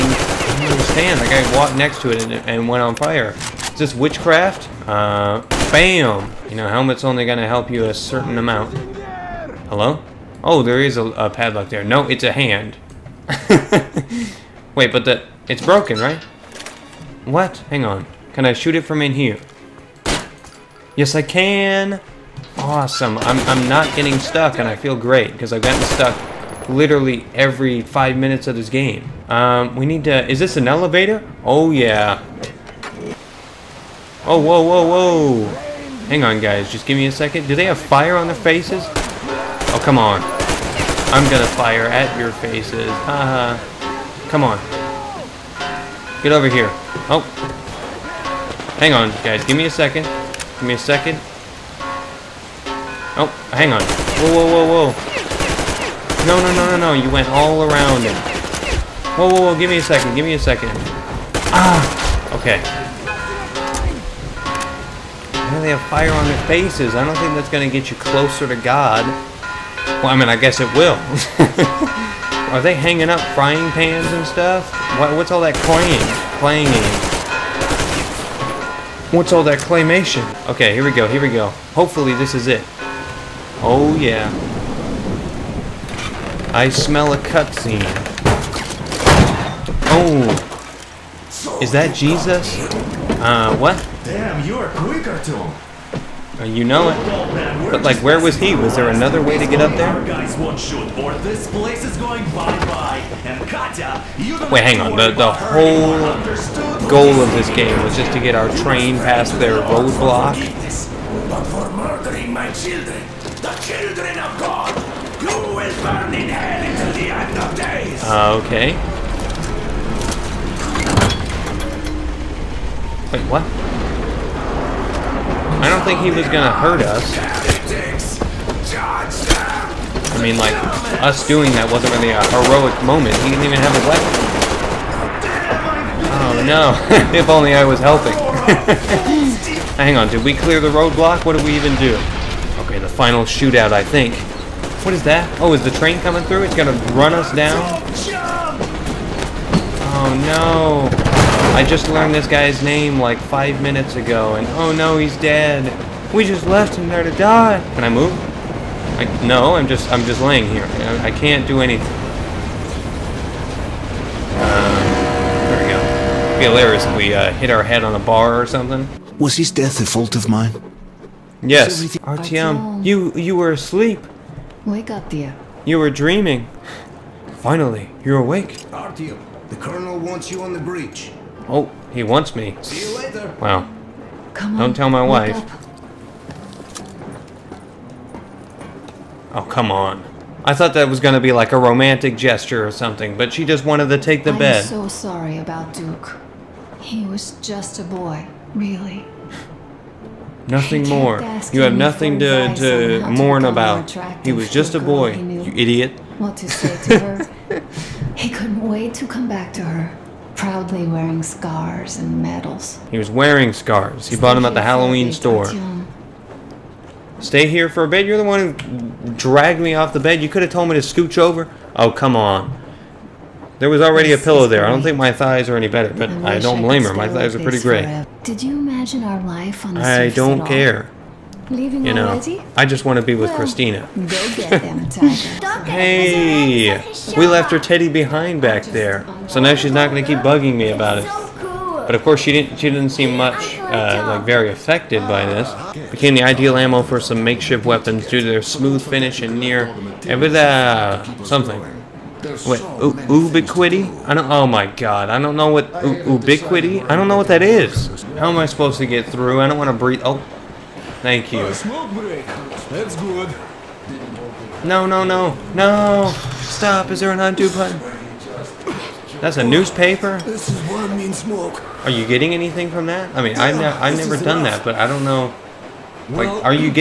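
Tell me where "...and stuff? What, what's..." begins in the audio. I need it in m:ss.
1:14.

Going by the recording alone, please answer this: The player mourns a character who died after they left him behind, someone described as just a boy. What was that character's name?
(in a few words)
Duke.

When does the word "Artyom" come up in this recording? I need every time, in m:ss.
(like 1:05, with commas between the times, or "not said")
1:35, 2:52, 2:58.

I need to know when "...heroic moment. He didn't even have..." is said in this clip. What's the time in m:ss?
2:12.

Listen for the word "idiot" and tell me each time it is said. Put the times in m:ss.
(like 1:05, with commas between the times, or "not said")
3:25.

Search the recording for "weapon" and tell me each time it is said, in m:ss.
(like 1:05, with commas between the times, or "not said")
2:13, 4:07.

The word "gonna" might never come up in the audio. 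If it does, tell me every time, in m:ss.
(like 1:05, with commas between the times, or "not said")
0:07, 0:41, 2:06, 2:26.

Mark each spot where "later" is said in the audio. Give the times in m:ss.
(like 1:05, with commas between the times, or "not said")
3:02.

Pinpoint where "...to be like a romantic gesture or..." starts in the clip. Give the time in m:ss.
3:11.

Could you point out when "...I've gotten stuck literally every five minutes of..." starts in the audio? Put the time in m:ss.
0:25.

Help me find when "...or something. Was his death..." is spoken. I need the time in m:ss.
2:48.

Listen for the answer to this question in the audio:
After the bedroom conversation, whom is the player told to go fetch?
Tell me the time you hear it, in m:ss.
3:54.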